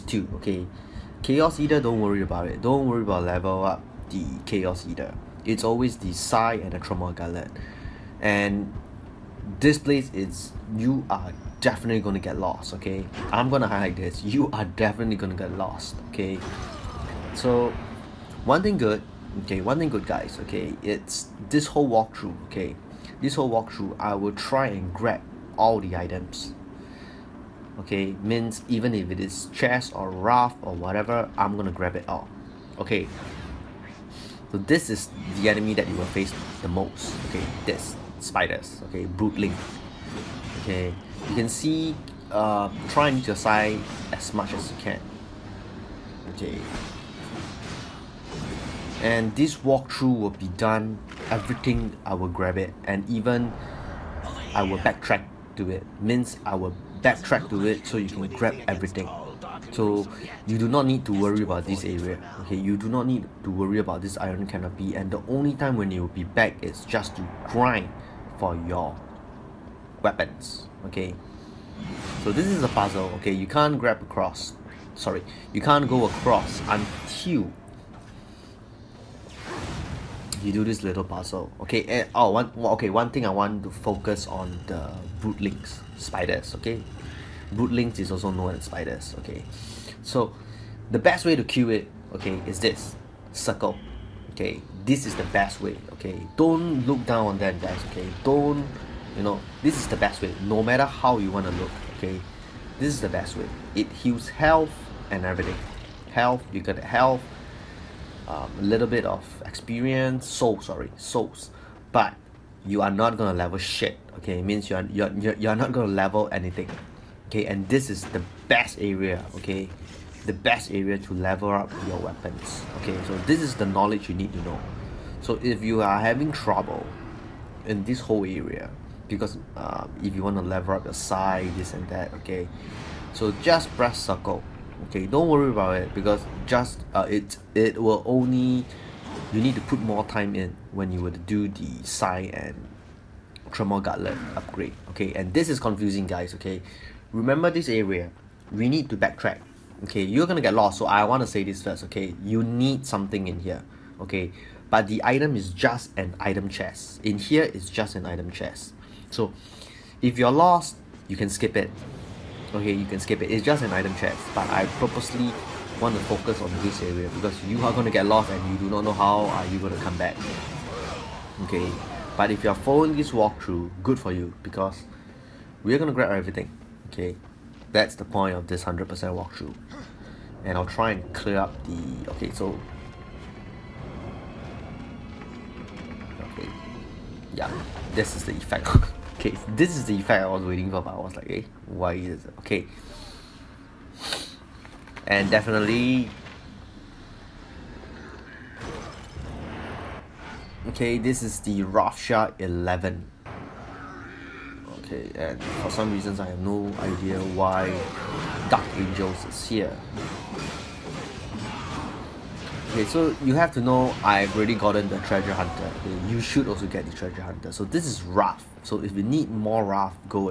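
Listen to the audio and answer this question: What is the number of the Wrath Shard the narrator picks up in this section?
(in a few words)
11.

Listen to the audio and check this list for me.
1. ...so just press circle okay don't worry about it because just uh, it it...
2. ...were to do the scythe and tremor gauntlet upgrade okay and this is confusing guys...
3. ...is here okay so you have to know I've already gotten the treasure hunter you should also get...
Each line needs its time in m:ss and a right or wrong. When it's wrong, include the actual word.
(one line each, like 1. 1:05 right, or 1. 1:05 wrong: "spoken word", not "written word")
1. 2:13 right
2. 2:21 right
3. 3:29 right.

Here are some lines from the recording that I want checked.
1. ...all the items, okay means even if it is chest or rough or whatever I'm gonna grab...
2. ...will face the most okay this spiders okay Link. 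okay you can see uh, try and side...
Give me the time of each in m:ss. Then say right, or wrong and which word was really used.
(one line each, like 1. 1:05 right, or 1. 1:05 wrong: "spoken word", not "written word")
1. 0:25 right
2. 0:35 right.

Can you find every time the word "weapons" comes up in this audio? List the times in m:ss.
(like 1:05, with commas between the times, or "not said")
1:10, 2:01.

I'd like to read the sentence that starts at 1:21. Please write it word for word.
Okay, and oh one okay, one thing I want to focus on the broodlings, spiders, okay?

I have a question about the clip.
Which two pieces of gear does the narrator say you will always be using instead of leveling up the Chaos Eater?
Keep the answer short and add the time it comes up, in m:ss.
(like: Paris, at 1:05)
Scythe and Tremor Gauntlet, at 0:05.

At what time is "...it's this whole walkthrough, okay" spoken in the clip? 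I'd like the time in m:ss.
0:20.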